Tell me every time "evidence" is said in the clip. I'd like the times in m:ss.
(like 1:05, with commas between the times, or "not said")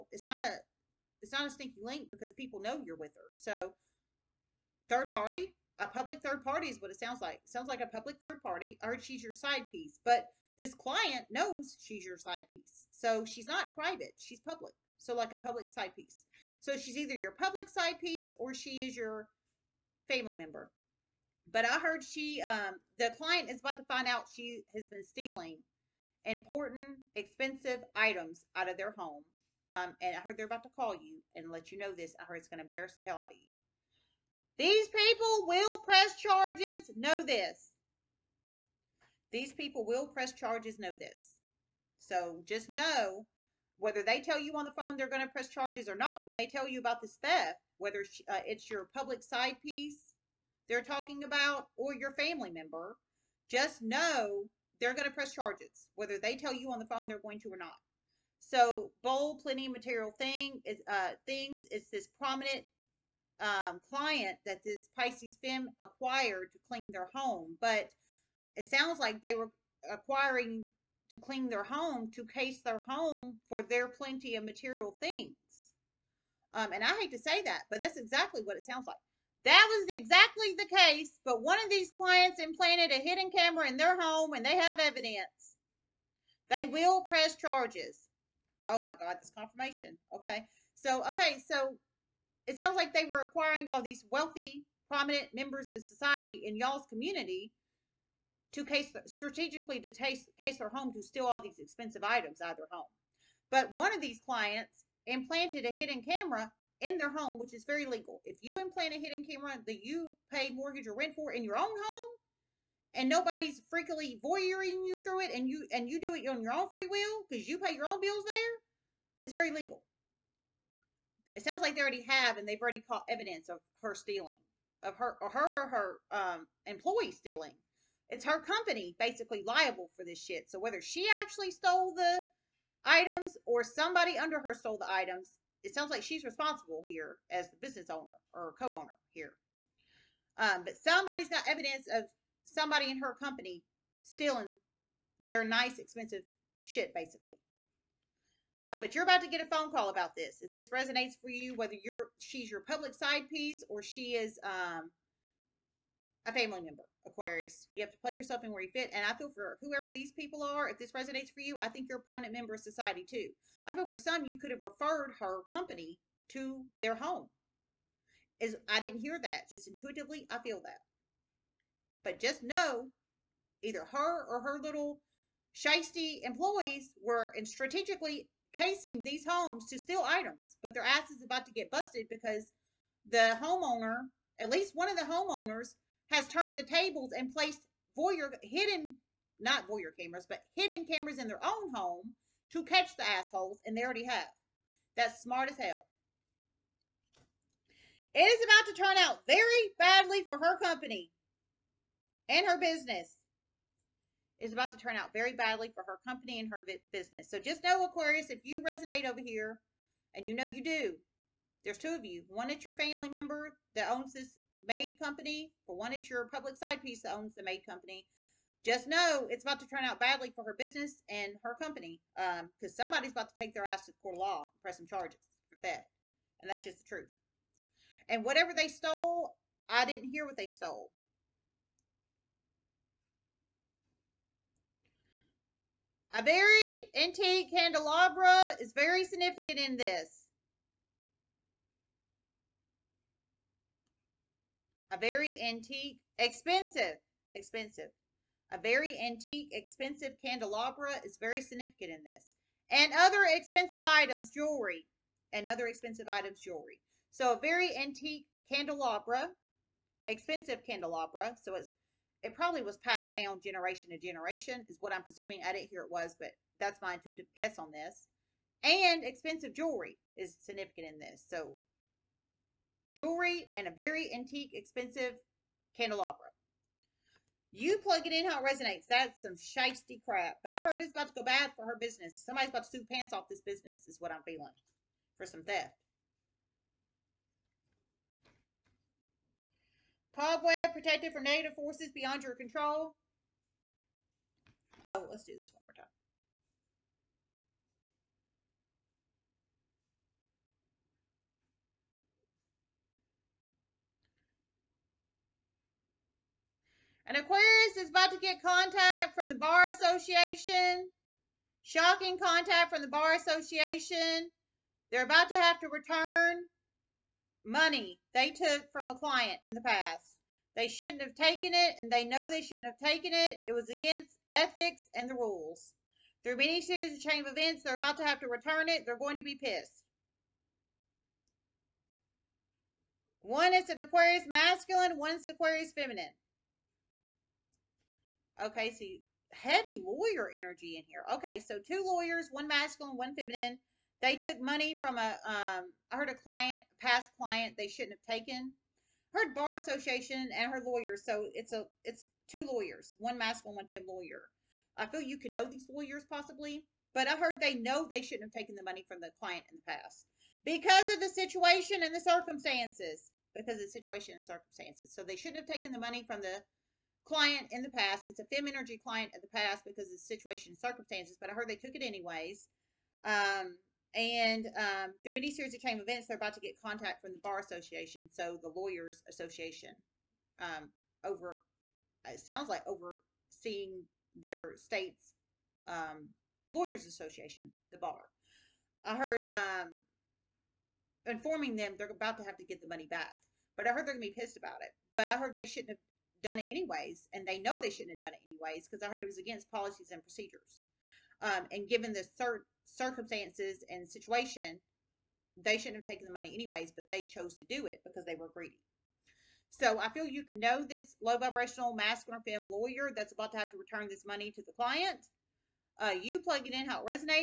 1:24, 2:03, 2:21.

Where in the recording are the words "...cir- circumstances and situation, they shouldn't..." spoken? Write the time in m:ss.
6:42.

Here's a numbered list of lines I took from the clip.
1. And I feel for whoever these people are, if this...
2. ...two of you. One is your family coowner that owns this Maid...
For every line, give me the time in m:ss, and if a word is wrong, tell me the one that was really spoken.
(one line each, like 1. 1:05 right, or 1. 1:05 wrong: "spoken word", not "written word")
1. 2:38 right
2. 3:31 wrong: "member", not "coowner".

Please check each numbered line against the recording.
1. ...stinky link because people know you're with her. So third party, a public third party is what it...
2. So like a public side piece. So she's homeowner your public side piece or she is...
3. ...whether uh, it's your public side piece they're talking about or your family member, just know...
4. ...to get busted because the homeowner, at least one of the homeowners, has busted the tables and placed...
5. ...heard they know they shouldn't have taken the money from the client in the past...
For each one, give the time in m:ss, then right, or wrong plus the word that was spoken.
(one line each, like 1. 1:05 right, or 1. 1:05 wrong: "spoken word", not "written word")
1. 0:01 right
2. 0:14 wrong: "either", not "homeowner"
3. 0:47 right
4. 3:01 wrong: "turned", not "busted"
5. 5:57 right.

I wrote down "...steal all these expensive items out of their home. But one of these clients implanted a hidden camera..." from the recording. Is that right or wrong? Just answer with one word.
right.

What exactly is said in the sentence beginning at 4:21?
So it's it probably was passed down generation to generation, is what I'm presuming.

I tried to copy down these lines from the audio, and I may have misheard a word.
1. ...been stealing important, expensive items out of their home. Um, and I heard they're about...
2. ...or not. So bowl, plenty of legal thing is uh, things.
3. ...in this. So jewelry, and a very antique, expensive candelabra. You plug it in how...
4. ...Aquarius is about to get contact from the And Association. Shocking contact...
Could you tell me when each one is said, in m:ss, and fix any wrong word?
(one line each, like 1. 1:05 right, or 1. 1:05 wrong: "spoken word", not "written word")
1. 0:24 right
2. 0:57 wrong: "material", not "legal"
3. 4:30 right
4. 5:07 wrong: "Bar", not "And".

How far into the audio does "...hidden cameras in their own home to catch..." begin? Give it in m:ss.
3:10.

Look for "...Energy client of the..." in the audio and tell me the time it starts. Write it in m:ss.
6:08.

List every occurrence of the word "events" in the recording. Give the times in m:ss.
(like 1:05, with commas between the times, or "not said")
5:27, 6:15.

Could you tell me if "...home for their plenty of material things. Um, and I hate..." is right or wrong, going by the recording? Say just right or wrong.
right.